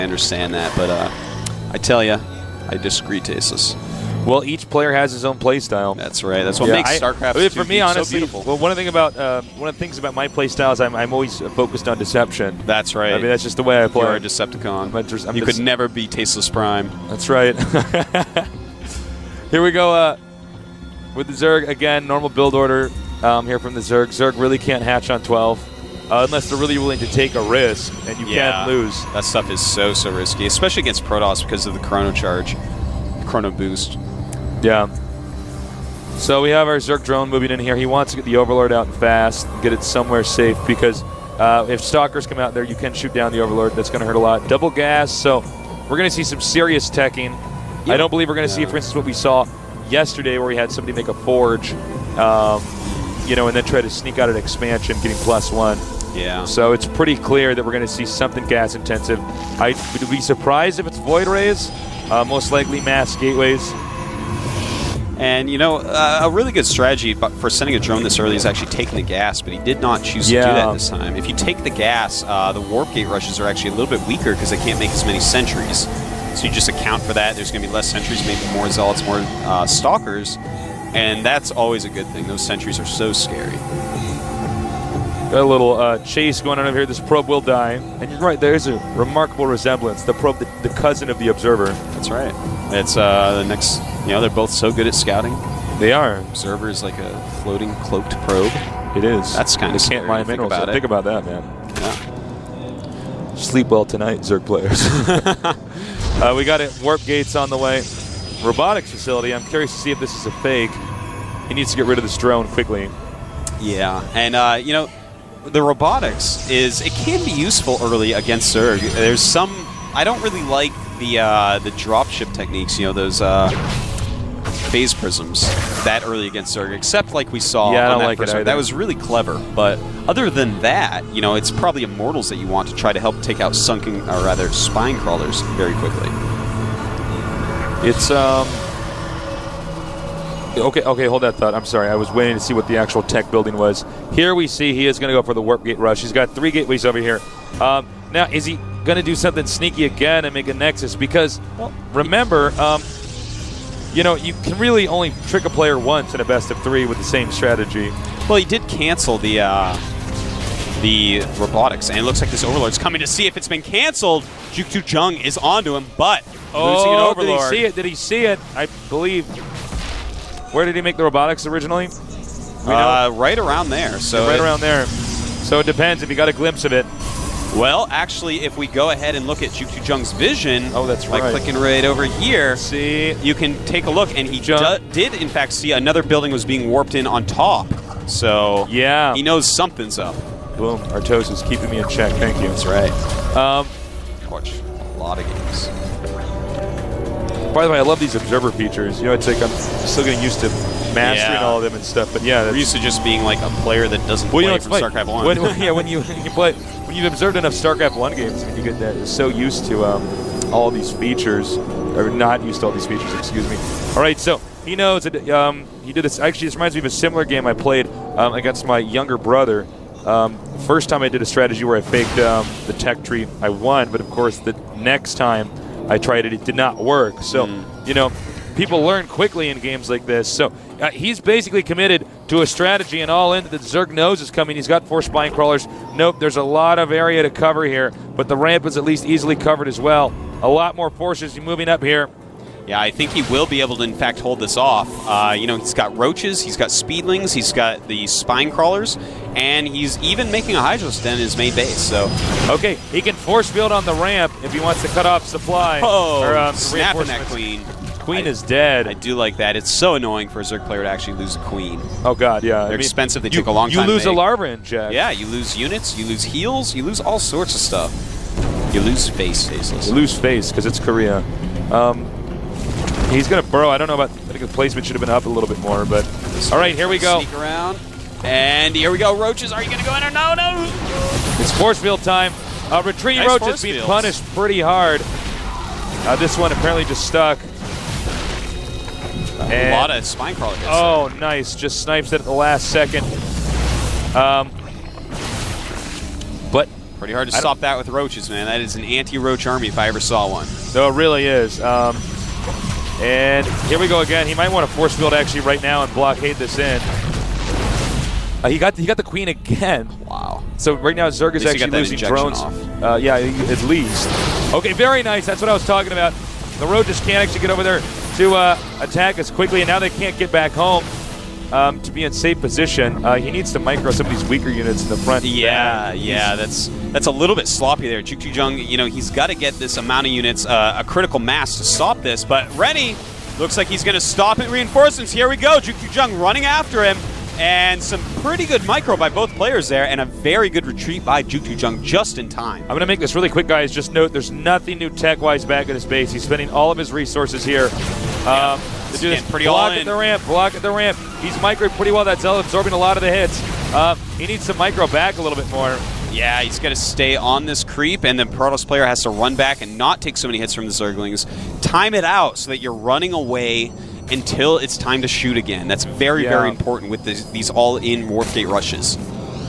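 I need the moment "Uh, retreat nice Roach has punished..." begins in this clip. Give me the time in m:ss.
4:42.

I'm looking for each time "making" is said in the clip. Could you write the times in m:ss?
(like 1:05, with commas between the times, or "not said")
4:10.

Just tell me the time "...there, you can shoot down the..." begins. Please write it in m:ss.
0:42.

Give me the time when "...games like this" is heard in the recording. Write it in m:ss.
3:49.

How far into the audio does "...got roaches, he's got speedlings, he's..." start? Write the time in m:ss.
4:05.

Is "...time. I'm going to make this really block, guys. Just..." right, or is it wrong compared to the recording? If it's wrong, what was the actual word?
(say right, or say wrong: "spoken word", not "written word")
wrong: "quick", not "block".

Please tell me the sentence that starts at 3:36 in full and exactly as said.
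Actually, this reminds me of a similar game I played um, against my younger brother.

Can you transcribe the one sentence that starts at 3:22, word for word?
But yeah, we're used to just being like a player that doesn't well, play you know, from StarCraft One.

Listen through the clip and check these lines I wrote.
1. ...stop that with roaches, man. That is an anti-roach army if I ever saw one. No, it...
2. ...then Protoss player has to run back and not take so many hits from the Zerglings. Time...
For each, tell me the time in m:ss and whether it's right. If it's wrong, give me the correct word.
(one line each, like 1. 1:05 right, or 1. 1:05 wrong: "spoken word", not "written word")
1. 4:57 right
2. 5:58 right.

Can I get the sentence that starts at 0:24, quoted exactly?
Zerg really can't hatch on 12.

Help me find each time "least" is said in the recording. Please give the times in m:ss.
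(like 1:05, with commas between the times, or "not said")
3:58, 5:13.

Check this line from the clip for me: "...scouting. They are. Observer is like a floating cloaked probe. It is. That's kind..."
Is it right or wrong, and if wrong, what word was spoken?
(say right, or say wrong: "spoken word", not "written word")
right.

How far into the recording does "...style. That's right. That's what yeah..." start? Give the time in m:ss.
0:05.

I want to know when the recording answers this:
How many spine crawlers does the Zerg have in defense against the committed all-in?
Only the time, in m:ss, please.
3:54.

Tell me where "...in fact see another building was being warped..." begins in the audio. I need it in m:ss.
3:05.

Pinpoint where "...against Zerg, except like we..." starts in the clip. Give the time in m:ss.
2:06.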